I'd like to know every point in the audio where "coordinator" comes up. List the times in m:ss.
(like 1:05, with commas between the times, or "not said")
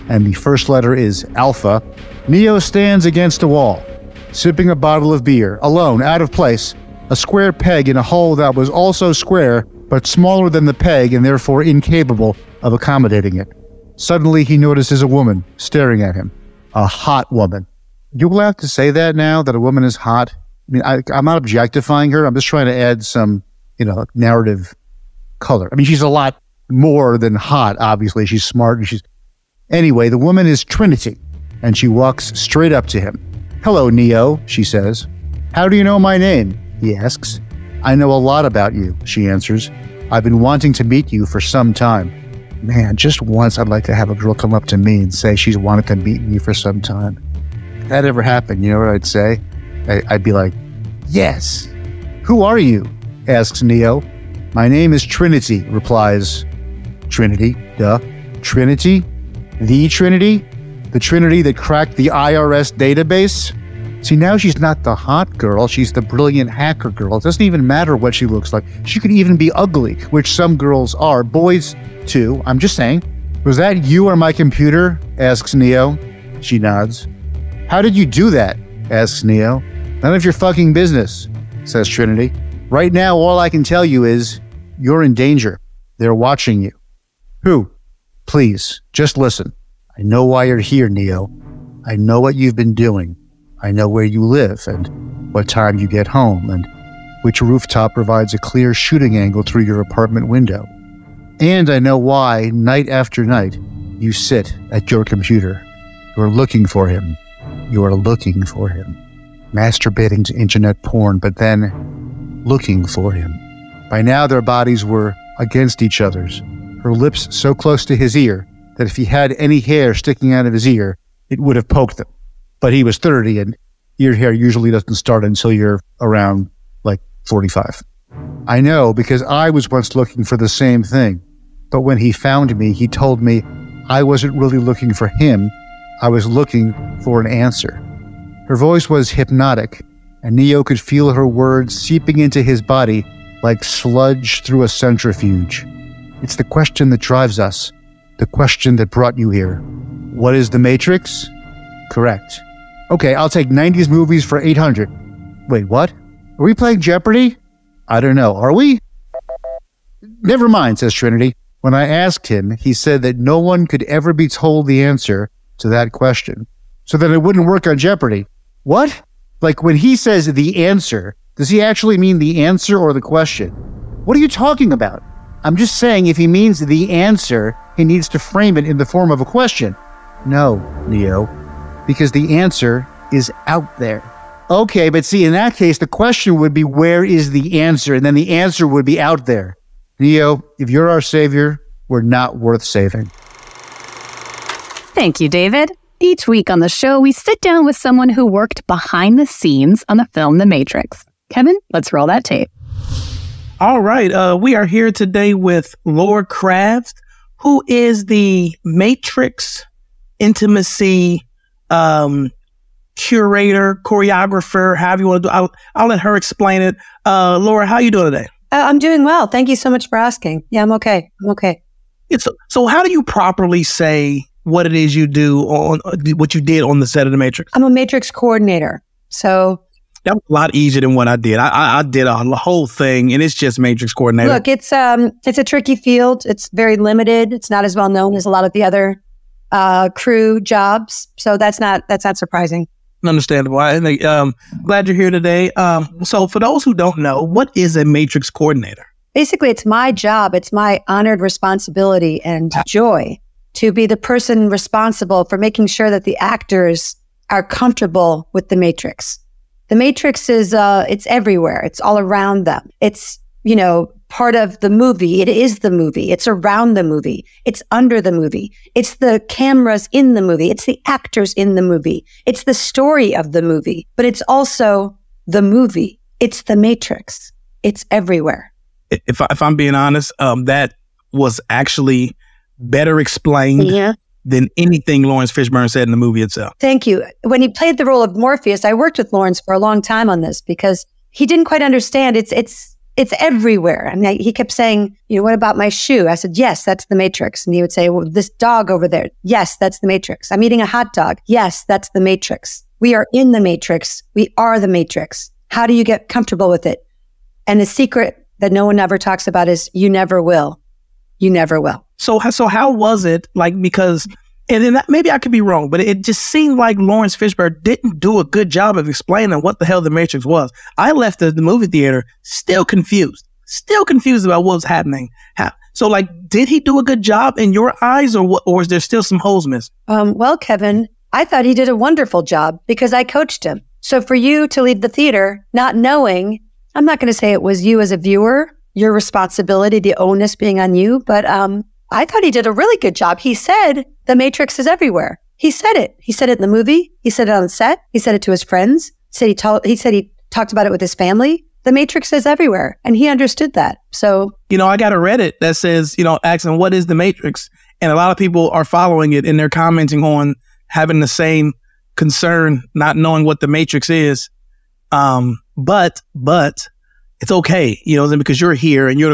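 3:48, 3:53, 4:08.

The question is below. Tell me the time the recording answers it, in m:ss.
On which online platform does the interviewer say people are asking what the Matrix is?
5:54.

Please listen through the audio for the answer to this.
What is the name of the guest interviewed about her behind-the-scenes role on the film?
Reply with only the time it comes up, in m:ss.
3:25.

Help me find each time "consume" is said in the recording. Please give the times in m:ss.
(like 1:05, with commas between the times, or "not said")
not said.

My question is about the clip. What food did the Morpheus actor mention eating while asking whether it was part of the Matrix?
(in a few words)
hot dog.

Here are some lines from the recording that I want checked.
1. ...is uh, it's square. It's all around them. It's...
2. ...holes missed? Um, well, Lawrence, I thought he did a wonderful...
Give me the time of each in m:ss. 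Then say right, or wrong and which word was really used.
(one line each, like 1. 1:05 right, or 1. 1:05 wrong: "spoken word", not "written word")
1. 4:20 wrong: "everywhere", not "square"
2. 5:29 wrong: "Kevin", not "Lawrence".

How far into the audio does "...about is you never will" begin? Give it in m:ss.
5:09.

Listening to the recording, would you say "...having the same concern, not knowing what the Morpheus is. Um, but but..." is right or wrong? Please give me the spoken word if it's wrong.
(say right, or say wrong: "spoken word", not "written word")
wrong: "Matrix", not "Morpheus".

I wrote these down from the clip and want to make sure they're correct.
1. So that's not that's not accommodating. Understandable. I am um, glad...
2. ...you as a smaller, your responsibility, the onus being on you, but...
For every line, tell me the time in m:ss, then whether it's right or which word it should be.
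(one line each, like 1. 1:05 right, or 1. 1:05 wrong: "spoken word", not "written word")
1. 4:01 wrong: "surprising", not "accommodating"
2. 5:37 wrong: "viewer", not "smaller".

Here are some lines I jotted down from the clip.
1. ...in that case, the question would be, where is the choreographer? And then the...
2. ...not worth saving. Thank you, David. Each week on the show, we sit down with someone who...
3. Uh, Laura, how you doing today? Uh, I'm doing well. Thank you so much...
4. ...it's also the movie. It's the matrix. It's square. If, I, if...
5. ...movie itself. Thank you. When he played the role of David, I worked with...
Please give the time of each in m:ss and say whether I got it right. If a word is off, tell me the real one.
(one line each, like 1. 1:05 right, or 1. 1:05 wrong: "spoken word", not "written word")
1. 3:05 wrong: "answer", not "choreographer"
2. 3:12 right
3. 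3:37 right
4. 4:34 wrong: "everywhere", not "square"
5. 4:45 wrong: "Morpheus", not "David".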